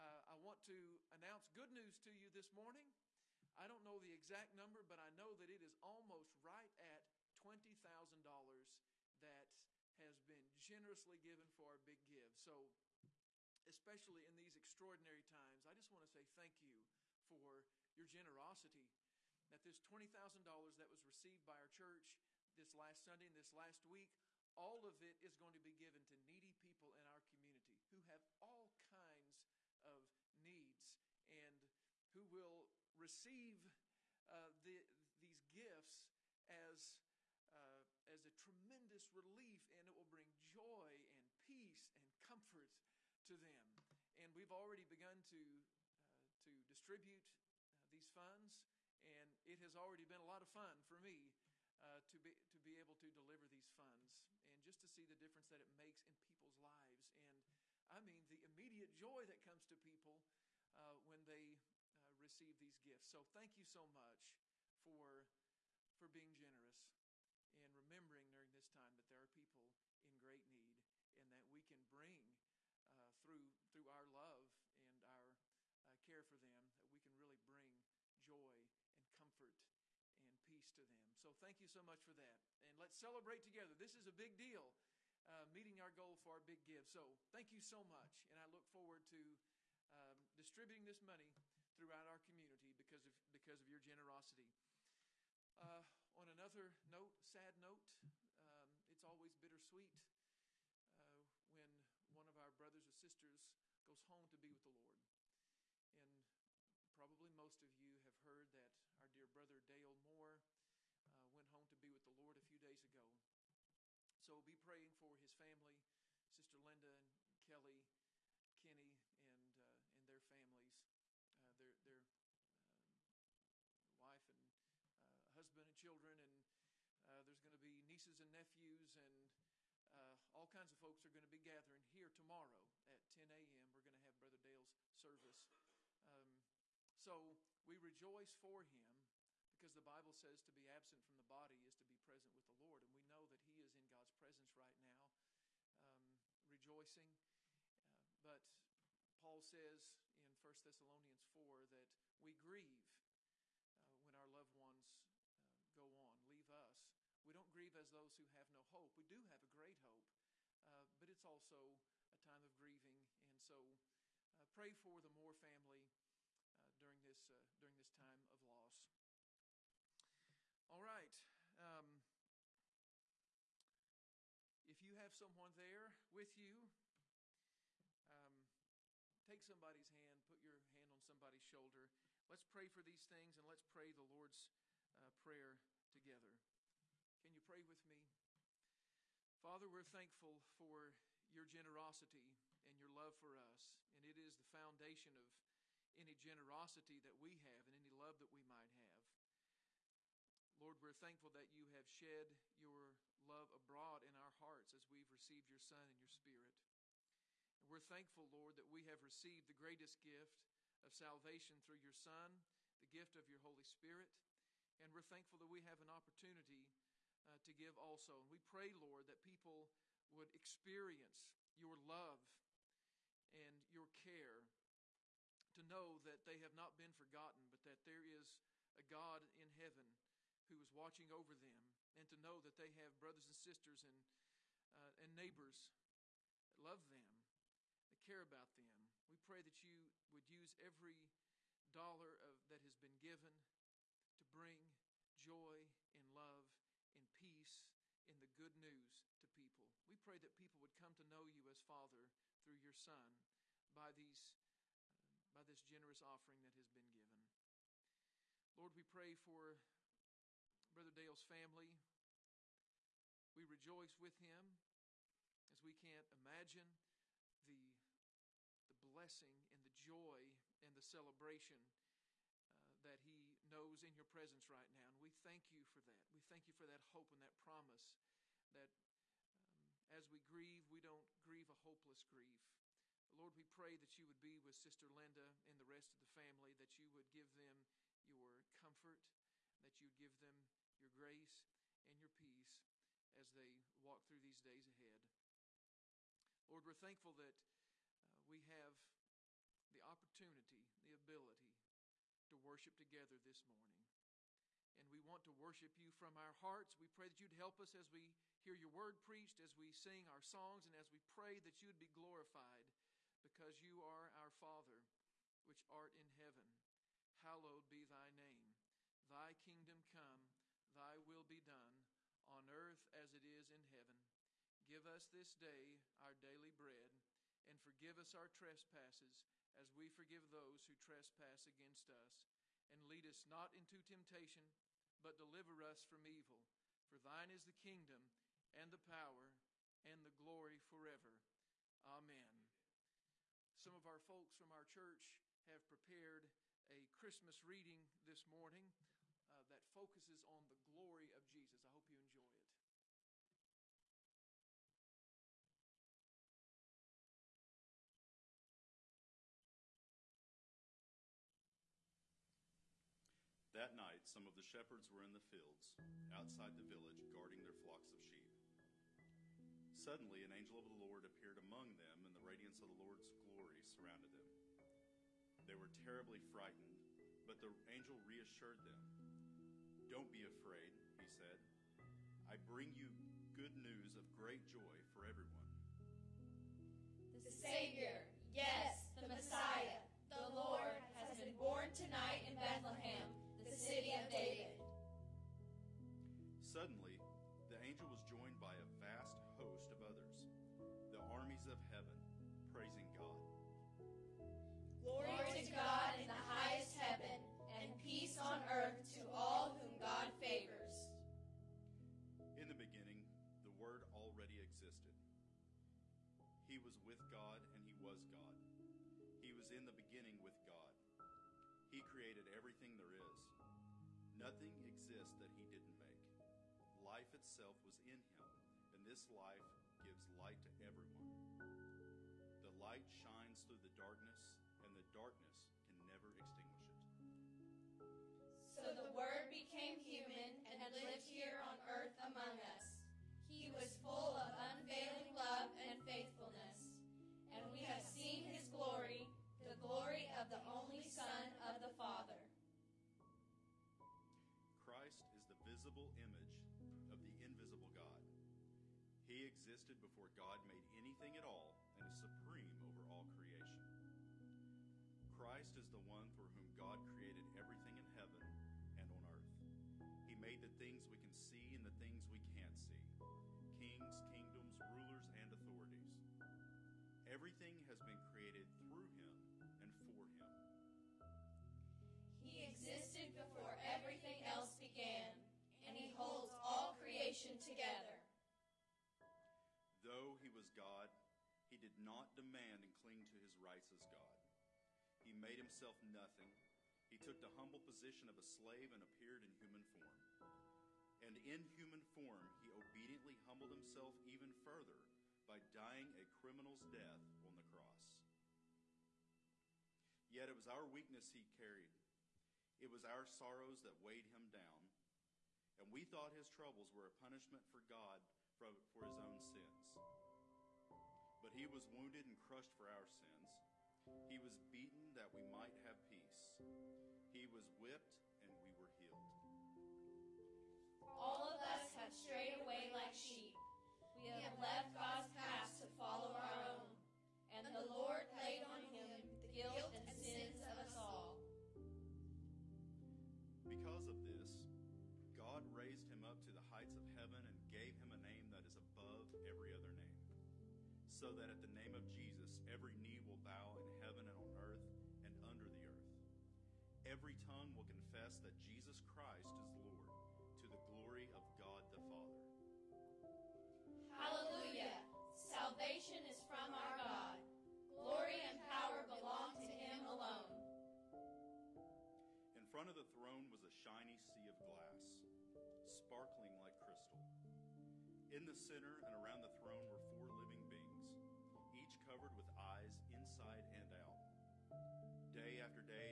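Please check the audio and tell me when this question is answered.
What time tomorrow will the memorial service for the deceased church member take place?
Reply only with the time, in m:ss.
2:13.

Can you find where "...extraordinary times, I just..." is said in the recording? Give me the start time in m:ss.
0:14.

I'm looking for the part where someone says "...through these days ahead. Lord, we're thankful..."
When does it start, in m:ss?
4:54.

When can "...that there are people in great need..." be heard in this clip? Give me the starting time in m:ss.
1:08.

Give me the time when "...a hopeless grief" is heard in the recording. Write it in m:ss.
4:41.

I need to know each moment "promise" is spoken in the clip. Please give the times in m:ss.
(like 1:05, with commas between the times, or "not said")
4:37.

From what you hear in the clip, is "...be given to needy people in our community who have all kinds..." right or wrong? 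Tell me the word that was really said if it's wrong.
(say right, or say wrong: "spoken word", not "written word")
right.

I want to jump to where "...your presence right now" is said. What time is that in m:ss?
4:33.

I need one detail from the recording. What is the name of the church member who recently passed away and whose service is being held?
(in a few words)
Dale Moore.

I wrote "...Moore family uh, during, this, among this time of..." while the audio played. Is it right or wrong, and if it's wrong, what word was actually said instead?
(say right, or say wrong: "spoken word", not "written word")
wrong: "during", not "among".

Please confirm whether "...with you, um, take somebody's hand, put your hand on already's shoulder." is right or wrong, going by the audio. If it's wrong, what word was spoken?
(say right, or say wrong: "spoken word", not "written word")
wrong: "somebody", not "already".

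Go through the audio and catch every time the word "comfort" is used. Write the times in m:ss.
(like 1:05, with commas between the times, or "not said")
0:42, 1:19, 4:48.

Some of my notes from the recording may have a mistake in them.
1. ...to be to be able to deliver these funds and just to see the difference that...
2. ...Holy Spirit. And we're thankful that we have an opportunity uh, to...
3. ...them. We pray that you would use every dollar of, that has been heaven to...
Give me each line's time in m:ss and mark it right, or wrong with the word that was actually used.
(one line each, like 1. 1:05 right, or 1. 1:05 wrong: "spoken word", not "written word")
1. 0:52 right
2. 3:33 right
3. 3:58 wrong: "given", not "heaven".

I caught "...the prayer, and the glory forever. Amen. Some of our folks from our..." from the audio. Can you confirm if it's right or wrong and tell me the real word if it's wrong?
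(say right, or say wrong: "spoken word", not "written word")
wrong: "power", not "prayer".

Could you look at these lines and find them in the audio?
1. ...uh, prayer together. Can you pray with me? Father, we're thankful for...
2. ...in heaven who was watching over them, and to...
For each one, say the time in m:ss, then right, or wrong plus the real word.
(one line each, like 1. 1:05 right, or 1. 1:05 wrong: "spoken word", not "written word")
1. 3:04 right
2. 3:49 right.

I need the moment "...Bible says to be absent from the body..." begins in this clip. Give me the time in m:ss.
2:19.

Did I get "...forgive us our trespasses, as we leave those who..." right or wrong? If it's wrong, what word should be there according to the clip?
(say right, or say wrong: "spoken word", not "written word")
wrong: "forgive", not "leave".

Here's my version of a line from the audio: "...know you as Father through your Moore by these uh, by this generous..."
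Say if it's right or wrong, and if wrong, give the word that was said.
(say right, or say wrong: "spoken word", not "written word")
wrong: "Son", not "Moore".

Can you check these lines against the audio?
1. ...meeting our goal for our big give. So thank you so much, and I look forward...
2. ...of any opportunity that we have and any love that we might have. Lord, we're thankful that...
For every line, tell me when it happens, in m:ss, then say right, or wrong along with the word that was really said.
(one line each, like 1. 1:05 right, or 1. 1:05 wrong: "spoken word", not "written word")
1. 1:25 right
2. 3:15 wrong: "generosity", not "opportunity".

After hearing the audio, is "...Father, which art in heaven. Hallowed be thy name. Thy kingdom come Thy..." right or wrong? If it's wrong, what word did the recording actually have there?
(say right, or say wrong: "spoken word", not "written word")
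right.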